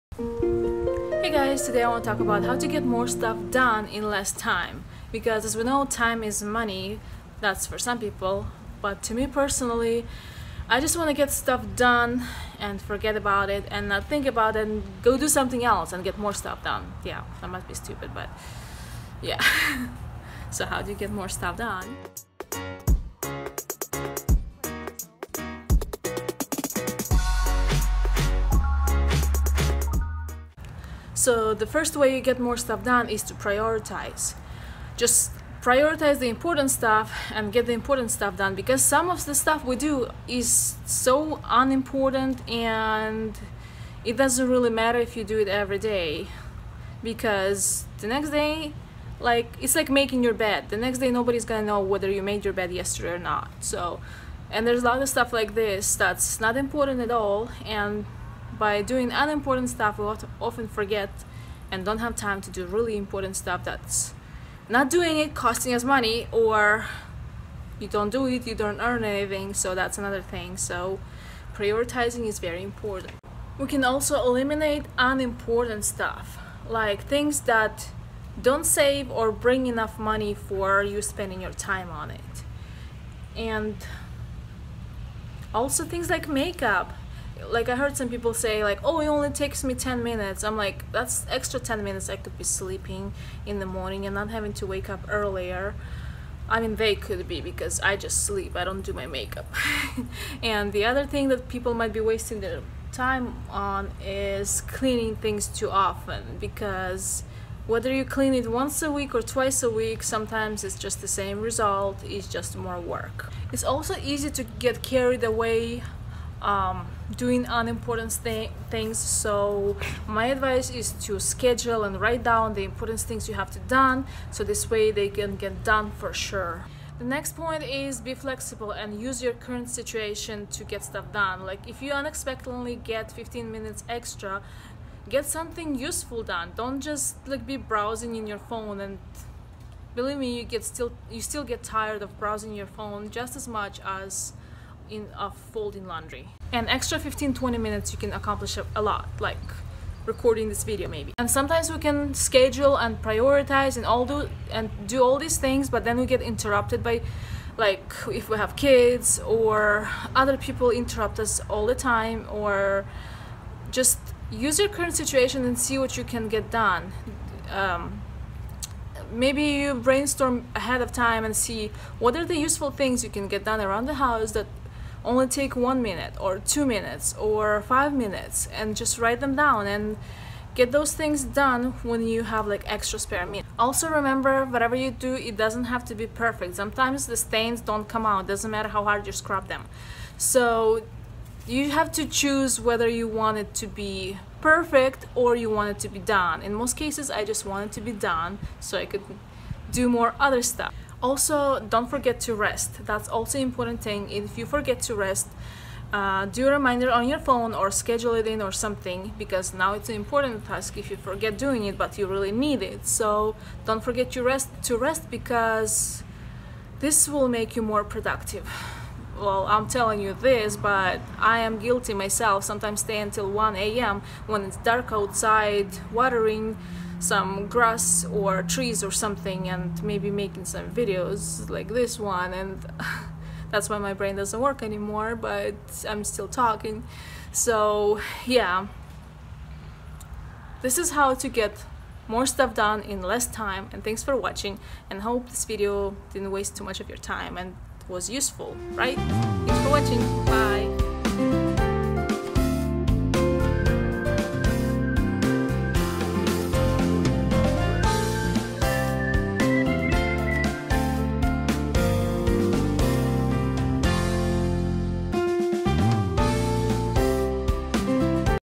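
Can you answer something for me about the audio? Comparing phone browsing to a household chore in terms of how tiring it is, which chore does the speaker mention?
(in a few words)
folding laundry.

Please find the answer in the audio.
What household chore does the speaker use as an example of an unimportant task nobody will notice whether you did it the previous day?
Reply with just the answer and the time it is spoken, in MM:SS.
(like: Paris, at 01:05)
making your bed, at 00:49.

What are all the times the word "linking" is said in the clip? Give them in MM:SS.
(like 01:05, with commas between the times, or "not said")
not said.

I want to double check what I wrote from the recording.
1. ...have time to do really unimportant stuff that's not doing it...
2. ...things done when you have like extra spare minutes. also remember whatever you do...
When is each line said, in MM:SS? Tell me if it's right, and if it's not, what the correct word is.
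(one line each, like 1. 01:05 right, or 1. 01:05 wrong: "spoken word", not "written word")
1. 01:01 wrong: "important", not "unimportant"
2. 03:00 right.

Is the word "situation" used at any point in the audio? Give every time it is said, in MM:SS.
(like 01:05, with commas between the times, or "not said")
02:09, 02:44.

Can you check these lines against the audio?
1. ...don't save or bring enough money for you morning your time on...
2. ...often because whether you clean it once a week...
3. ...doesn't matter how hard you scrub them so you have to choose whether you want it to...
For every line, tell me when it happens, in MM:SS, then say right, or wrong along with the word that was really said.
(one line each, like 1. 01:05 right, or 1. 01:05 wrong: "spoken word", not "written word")
1. 01:18 wrong: "spending", not "morning"
2. 01:45 right
3. 03:08 right.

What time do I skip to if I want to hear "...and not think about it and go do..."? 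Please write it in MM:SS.
00:13.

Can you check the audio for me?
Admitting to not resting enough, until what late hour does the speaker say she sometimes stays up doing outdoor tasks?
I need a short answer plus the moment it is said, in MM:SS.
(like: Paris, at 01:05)
1 a.m., at 03:43.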